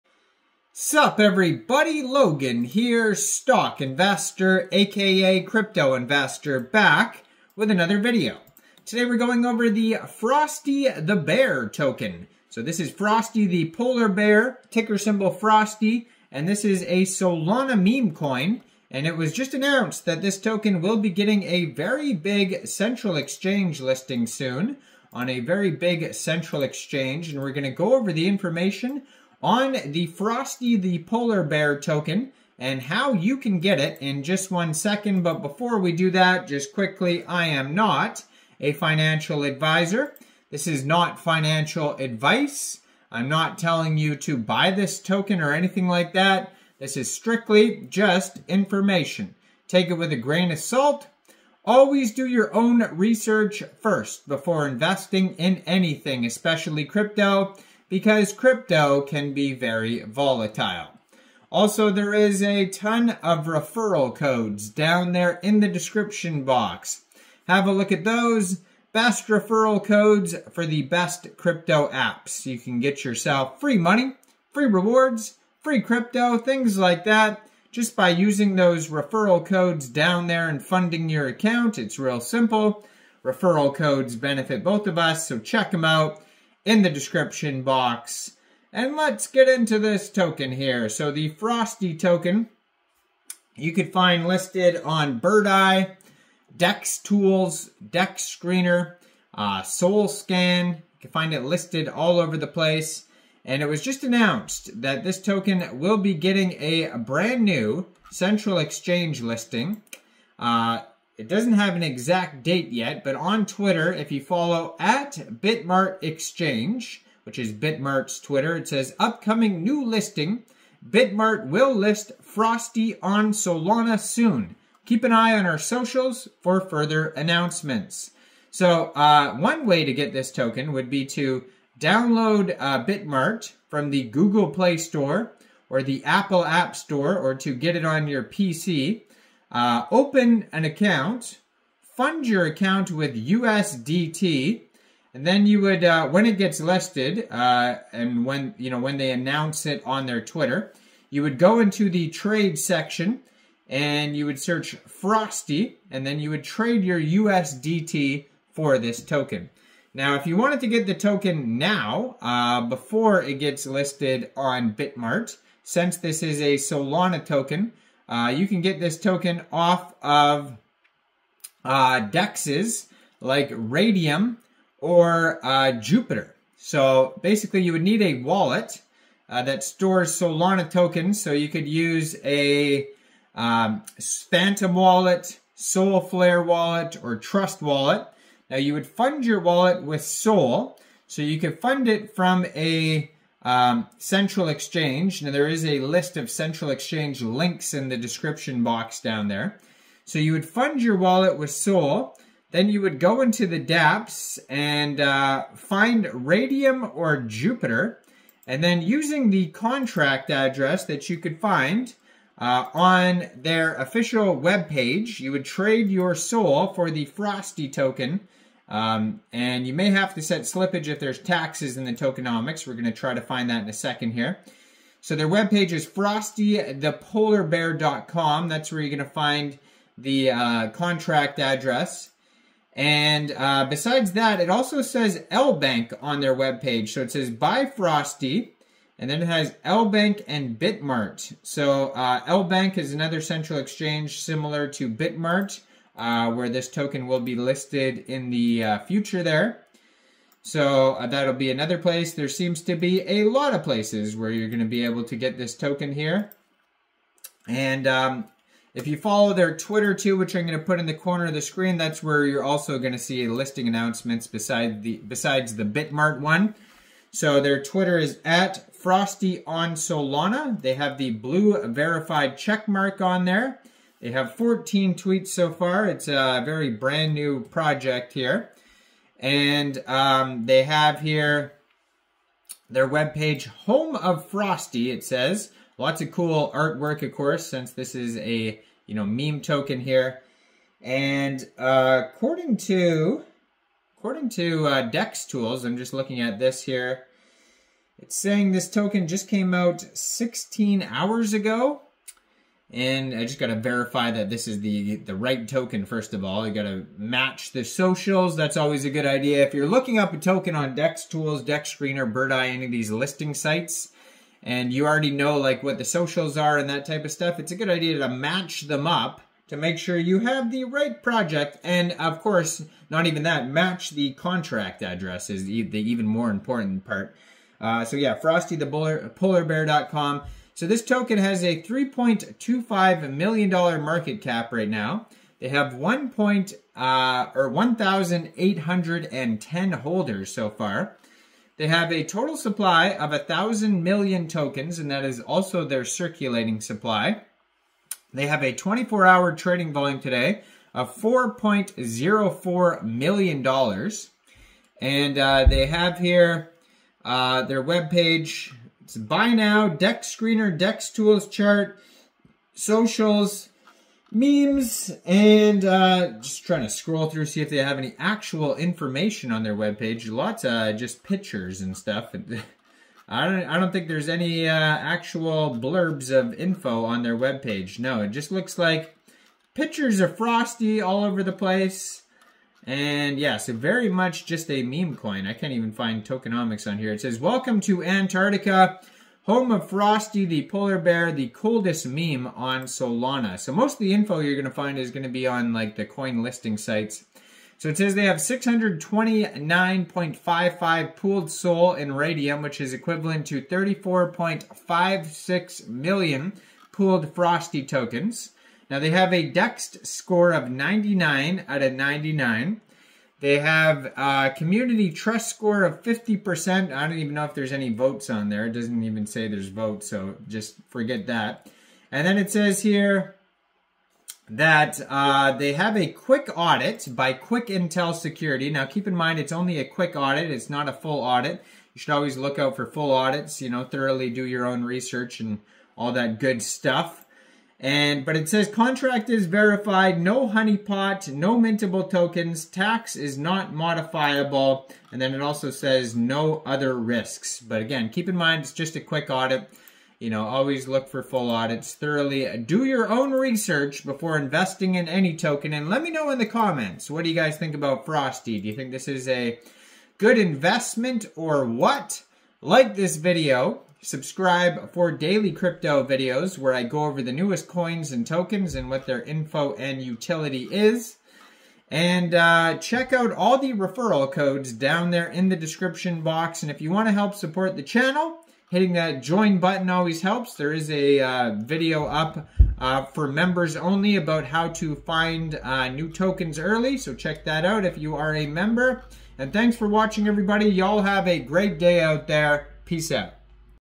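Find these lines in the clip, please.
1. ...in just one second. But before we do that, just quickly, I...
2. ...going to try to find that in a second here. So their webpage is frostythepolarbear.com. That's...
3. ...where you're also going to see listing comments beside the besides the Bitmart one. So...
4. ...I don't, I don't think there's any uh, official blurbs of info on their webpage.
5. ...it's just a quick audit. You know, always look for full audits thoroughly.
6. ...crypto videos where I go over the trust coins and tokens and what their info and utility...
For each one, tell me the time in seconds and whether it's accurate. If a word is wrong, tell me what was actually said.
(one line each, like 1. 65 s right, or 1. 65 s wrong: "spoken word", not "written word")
1. 34 s right
2. 222 s right
3. 262 s wrong: "announcements", not "comments"
4. 373 s wrong: "actual", not "official"
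5. 448 s right
6. 465 s wrong: "newest", not "trust".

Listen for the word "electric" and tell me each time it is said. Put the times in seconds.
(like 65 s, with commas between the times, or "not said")
not said.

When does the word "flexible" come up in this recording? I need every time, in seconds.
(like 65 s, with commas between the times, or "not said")
not said.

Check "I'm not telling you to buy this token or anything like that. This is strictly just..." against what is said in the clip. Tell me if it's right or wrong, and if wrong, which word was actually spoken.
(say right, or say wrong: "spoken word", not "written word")
right.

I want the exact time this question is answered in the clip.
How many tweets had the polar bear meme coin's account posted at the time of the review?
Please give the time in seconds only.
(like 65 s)
274 s.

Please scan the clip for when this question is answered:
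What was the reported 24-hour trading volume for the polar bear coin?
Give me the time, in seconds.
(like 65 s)
350 s.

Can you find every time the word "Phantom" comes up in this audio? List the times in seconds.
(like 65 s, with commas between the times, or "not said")
184 s.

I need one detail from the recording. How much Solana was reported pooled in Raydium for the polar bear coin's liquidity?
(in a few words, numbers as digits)
629.55.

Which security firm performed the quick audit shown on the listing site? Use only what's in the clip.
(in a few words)
Quick Intel.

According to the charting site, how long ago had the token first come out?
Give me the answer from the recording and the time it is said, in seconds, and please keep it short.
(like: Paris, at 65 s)
16 hours, at 299 s.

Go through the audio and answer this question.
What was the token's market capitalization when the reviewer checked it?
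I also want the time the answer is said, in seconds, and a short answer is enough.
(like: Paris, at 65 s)
$3.25 million, at 331 s.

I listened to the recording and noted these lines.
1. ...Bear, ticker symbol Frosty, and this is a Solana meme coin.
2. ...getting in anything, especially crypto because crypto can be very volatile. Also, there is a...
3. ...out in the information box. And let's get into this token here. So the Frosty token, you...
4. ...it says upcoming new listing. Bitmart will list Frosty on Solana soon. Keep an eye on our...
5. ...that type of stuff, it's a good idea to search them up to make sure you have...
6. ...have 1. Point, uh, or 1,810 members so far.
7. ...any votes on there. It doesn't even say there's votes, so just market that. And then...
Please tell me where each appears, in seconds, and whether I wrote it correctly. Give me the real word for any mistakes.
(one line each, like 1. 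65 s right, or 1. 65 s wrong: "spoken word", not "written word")
1. 14 s right
2. 54 s wrong: "investing", not "getting"
3. 85 s wrong: "description", not "information"
4. 118 s right
5. 316 s wrong: "match", not "search"
6. 335 s wrong: "holders", not "members"
7. 417 s wrong: "forget", not "market".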